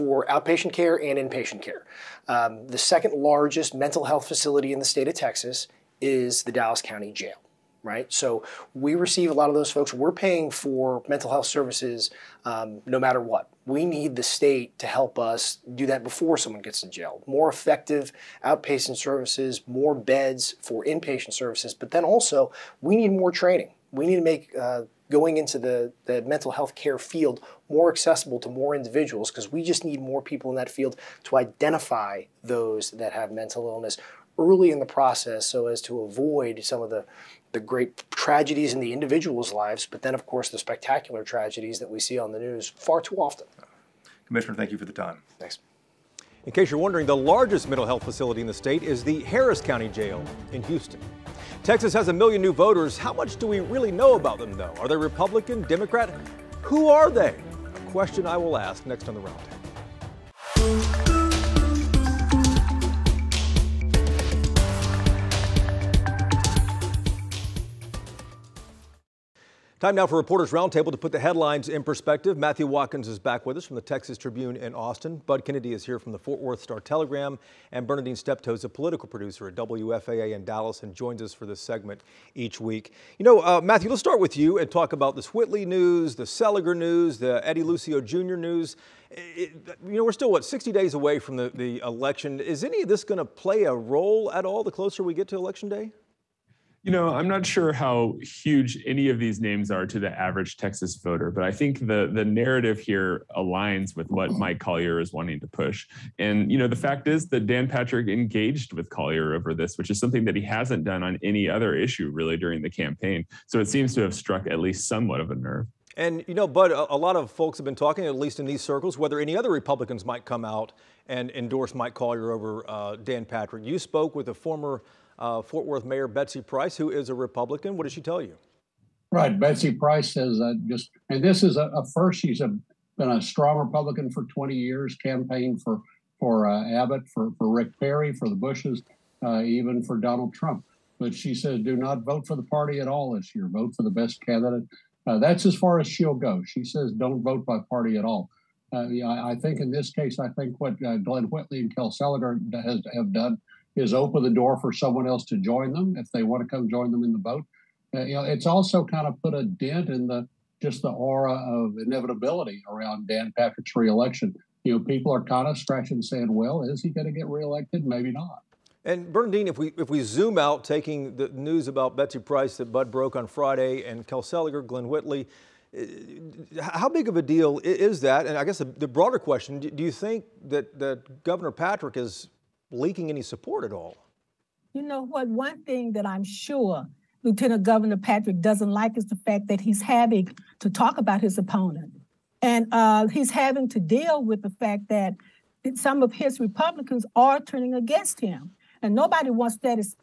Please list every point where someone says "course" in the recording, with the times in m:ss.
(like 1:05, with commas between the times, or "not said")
0:40.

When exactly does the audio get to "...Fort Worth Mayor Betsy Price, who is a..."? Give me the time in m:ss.
2:05.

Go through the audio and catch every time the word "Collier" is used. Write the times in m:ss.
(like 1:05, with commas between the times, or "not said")
1:44, 1:48, 2:01.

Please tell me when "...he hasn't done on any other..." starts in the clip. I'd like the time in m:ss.
1:50.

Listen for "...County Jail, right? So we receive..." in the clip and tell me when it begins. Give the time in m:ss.
0:06.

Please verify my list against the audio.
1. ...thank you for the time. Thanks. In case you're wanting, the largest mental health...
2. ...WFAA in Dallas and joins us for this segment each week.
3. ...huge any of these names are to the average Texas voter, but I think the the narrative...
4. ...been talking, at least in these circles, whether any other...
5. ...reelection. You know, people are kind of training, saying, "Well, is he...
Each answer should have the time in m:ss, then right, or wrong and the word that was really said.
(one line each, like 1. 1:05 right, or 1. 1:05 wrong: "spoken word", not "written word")
1. 0:44 wrong: "wondering", not "wanting"
2. 1:19 right
3. 1:38 right
4. 1:57 right
5. 2:43 wrong: "scratching", not "training".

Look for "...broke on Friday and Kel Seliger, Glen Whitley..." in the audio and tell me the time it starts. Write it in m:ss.
2:52.